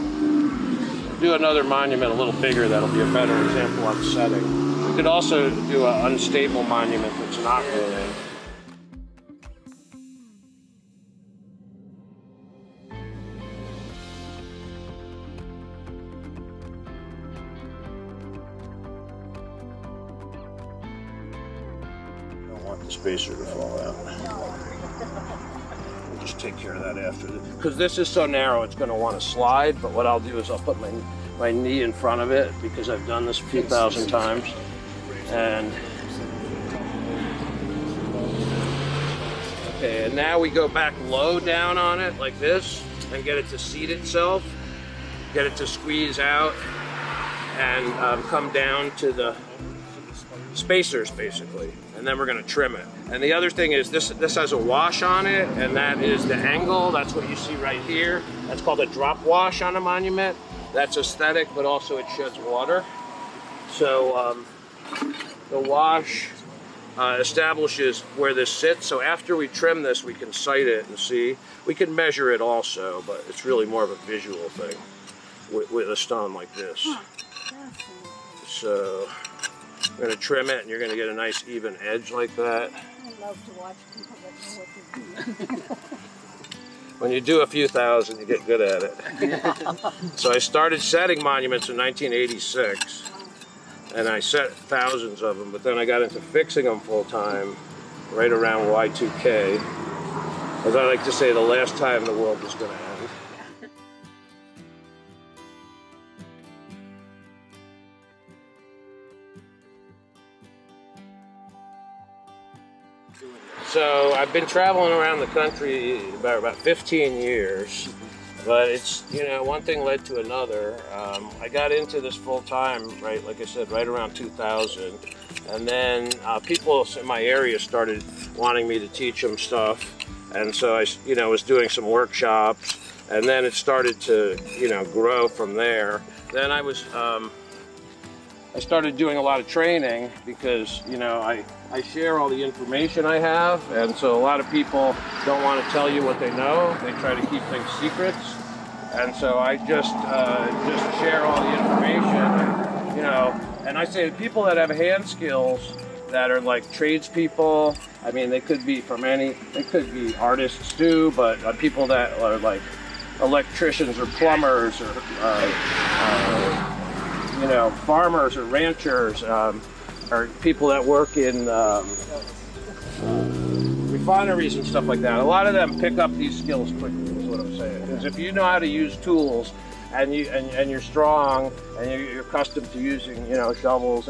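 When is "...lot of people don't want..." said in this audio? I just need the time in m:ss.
2:24.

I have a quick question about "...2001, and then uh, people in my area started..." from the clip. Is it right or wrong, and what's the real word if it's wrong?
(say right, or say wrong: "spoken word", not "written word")
wrong: "2000", not "2001".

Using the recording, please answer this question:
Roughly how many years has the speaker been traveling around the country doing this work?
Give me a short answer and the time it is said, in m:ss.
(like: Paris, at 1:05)
15, at 1:56.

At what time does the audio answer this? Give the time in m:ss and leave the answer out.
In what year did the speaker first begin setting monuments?
1:31.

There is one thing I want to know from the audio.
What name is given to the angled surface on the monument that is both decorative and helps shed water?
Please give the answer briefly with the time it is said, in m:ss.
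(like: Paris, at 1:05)
drop wash, at 0:58.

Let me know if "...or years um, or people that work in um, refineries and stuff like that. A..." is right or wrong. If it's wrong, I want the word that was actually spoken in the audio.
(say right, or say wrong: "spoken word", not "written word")
wrong: "ranchers", not "years".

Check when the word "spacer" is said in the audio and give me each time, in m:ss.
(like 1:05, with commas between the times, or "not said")
0:22, 0:50.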